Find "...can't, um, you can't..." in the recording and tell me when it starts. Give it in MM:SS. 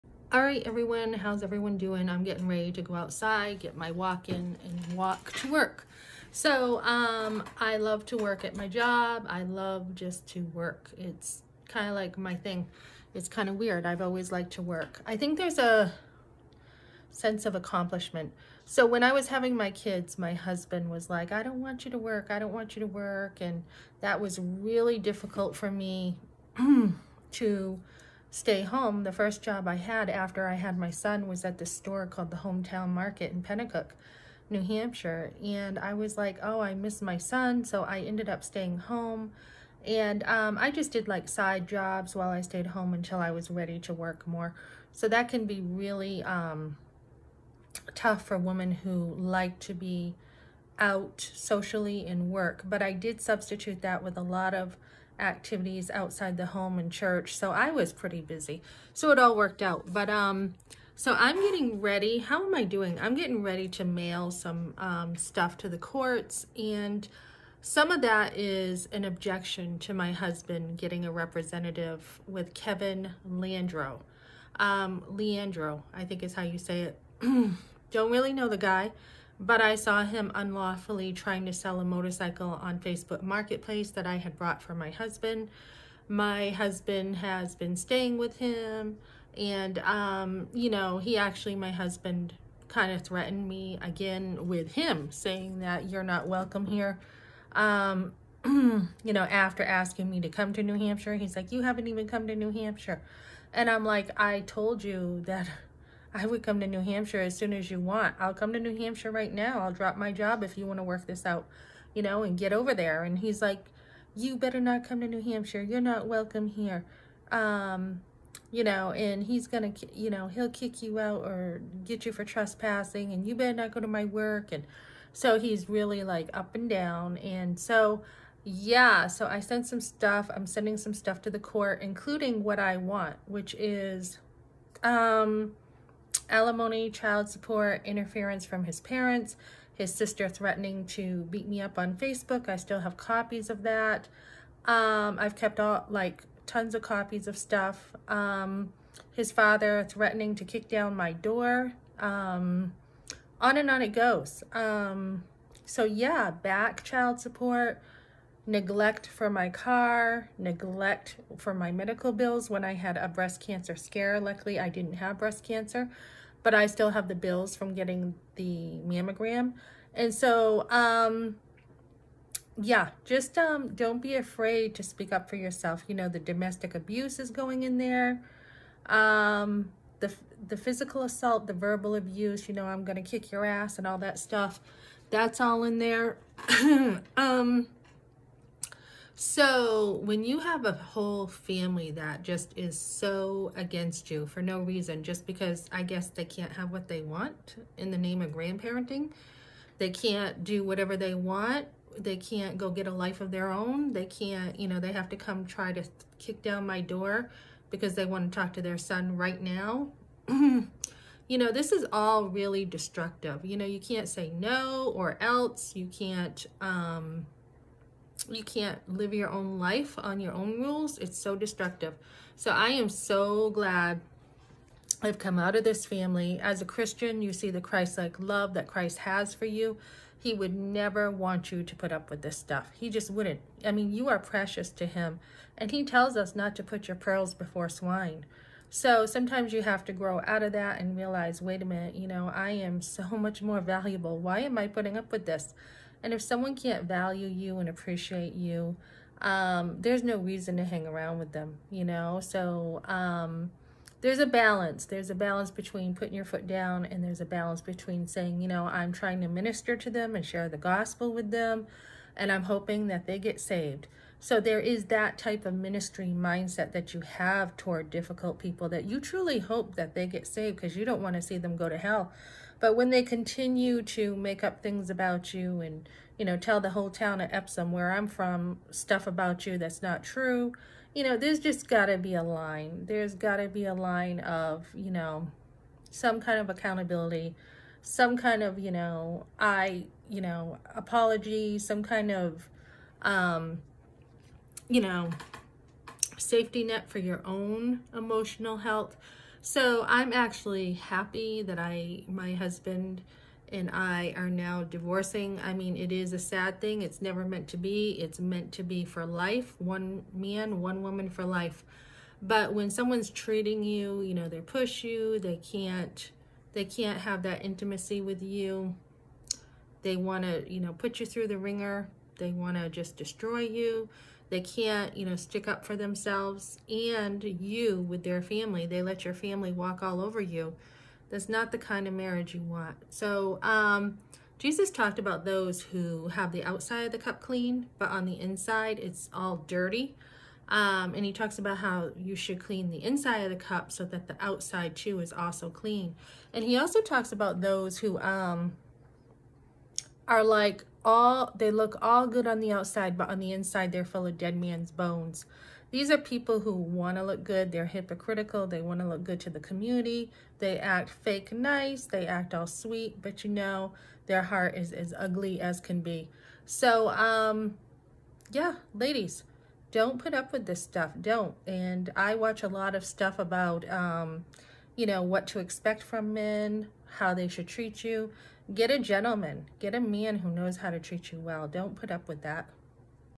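03:35.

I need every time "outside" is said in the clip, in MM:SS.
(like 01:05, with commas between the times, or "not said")
00:02, 00:55, 05:36, 05:44, 05:52.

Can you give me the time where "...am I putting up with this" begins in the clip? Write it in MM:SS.
04:04.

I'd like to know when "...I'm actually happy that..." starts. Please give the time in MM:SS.
04:59.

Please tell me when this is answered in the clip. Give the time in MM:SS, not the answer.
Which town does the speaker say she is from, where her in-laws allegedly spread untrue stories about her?
04:37.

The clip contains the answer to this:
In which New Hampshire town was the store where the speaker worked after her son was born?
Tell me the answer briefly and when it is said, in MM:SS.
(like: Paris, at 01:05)
Penacook, at 00:33.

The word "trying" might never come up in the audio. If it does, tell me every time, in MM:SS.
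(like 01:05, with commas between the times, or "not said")
01:21, 04:18.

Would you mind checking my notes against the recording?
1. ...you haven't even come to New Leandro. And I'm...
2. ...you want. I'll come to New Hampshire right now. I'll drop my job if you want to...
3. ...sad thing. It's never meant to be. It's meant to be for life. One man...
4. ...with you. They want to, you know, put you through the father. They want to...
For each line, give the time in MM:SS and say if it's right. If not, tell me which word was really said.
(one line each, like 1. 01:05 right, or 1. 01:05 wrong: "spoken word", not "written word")
1. 01:41 wrong: "Hampshire", not "Leandro"
2. 01:47 right
3. 05:06 right
4. 05:17 wrong: "ringer", not "father".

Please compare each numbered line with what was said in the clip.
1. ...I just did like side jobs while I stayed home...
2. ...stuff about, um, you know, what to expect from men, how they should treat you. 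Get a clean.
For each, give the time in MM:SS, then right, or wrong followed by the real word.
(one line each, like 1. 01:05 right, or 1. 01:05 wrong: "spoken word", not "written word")
1. 00:40 right
2. 06:12 wrong: "gentleman", not "clean".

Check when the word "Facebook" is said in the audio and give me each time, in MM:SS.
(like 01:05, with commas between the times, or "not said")
01:22, 02:21.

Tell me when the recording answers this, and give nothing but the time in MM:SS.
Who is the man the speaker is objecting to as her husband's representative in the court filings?
01:12.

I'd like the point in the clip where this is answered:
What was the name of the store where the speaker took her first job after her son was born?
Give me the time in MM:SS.
00:32.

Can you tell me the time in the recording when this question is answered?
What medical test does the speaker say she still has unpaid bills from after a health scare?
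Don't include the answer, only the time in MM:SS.
02:48.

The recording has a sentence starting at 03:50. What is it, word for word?
He would never want you to put up with this stuff.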